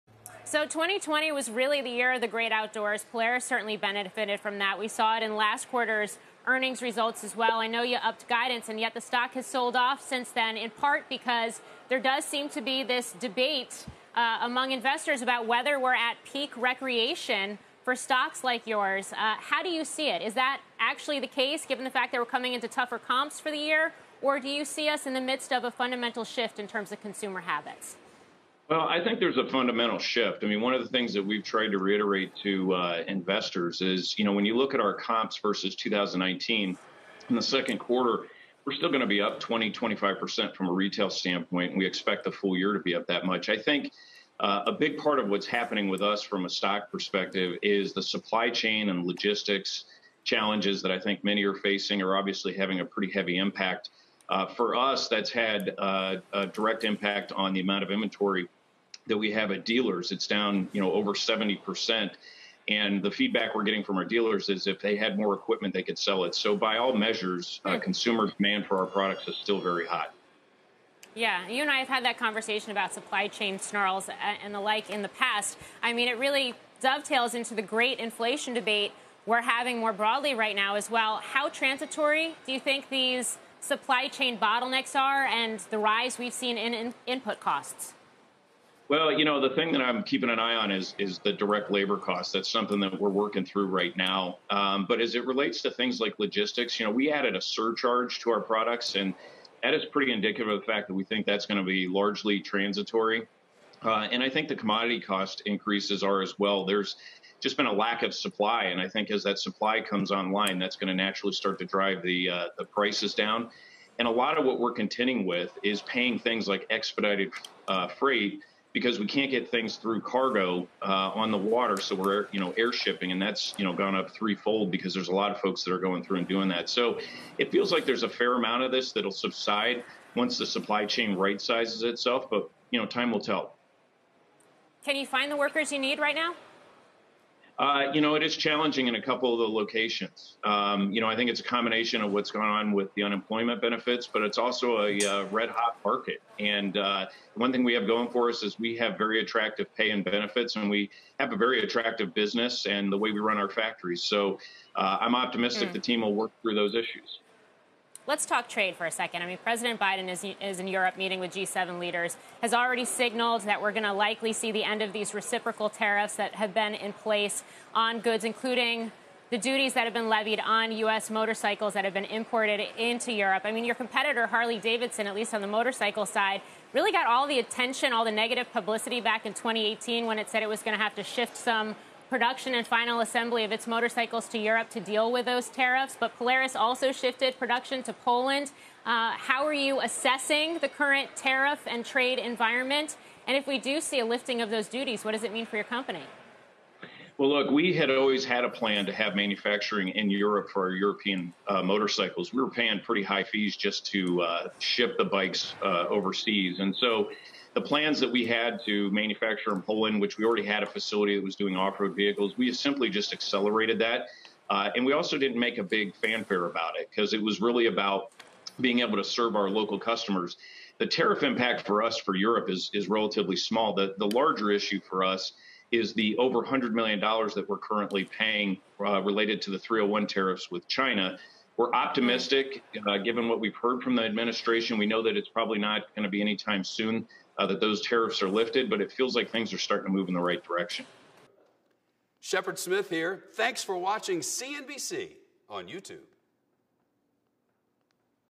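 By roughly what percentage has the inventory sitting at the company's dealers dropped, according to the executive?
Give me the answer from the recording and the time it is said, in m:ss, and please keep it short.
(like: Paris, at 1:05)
over 70%, at 1:00.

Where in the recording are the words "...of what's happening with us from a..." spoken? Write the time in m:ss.
0:45.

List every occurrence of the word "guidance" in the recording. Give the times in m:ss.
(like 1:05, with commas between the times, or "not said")
0:08.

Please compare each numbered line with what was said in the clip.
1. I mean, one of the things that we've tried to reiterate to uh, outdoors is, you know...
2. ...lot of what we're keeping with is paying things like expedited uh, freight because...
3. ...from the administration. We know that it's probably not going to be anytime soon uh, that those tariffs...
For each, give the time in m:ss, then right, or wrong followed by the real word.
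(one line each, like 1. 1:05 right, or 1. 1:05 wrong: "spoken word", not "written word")
1. 0:30 wrong: "investors", not "outdoors"
2. 1:54 wrong: "contending", not "keeping"
3. 3:53 right.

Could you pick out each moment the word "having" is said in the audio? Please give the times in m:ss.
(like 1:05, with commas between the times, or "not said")
0:52, 1:19.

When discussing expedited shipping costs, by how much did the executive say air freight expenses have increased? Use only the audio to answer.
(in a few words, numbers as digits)
threefold.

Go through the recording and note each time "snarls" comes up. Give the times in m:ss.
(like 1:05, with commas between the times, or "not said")
1:13.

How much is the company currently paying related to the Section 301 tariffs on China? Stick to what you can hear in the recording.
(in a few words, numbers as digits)
over $100 million.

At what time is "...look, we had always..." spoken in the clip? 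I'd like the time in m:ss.
3:17.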